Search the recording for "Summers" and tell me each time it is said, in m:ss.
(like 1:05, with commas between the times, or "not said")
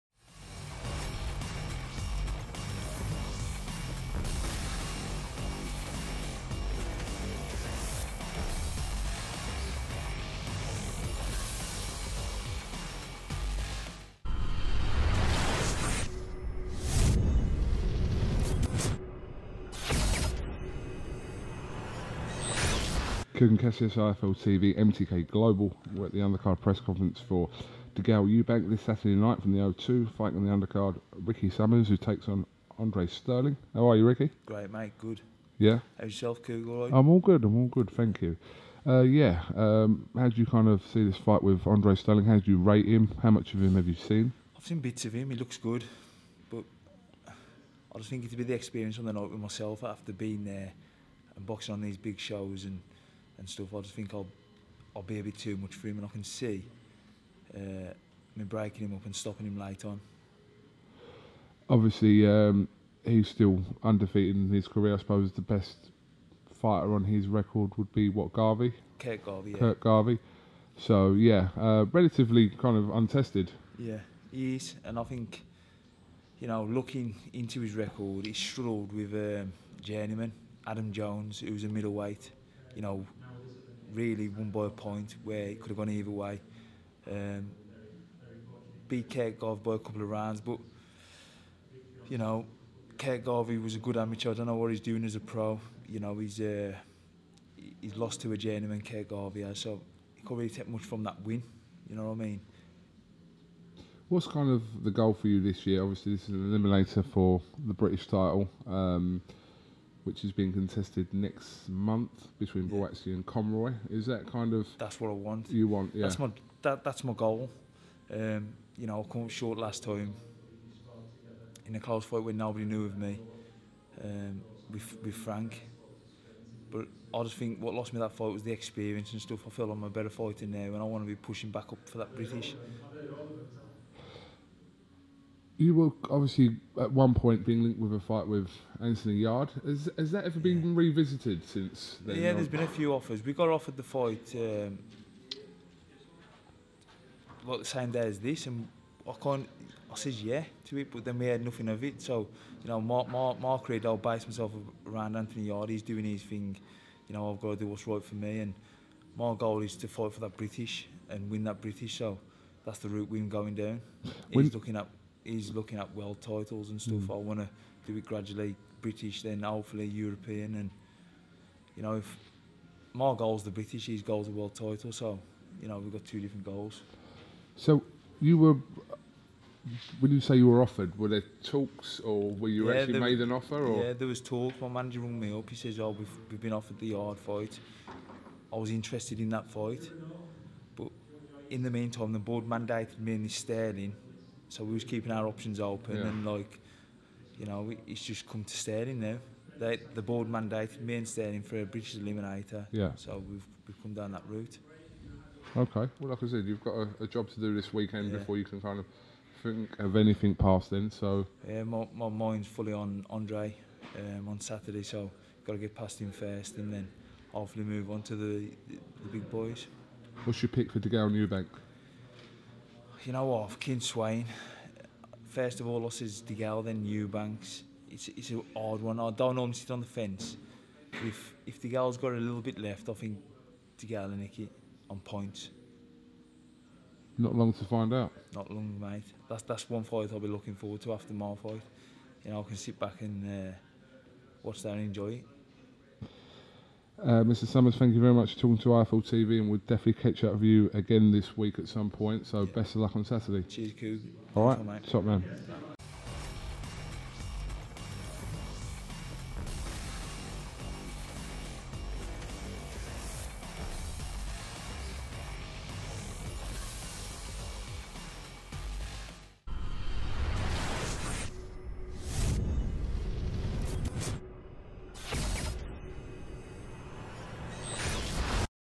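0:31, 4:07.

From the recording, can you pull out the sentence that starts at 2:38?
And my goal is to fight for that British and win that British.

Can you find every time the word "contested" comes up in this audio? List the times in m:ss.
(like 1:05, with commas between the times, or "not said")
1:50.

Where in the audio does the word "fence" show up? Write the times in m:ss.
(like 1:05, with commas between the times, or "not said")
3:49.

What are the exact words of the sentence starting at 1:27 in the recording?
Um, beat by a couple of rounds, but you know, Kirk Garvey he was a good amateur.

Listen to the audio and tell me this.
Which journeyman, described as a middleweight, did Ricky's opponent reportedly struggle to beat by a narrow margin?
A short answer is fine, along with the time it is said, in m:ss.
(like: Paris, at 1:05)
Adam Jones, at 1:20.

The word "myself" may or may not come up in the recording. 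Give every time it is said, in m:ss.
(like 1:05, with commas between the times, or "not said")
0:49, 2:34.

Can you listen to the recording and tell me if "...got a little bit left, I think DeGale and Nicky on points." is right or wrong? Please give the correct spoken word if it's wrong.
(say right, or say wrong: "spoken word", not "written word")
right.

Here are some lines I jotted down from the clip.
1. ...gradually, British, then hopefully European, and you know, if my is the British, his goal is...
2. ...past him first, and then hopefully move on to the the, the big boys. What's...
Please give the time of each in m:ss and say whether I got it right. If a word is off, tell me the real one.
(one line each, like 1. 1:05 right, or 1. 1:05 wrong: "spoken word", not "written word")
1. 2:48 right
2. 3:35 right.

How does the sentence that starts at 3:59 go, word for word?
That's that's one fight I'll be looking forward to after my fight.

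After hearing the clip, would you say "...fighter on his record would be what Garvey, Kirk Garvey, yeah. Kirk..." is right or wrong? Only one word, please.
right.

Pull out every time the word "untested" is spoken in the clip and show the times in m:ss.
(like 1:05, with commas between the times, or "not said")
1:12.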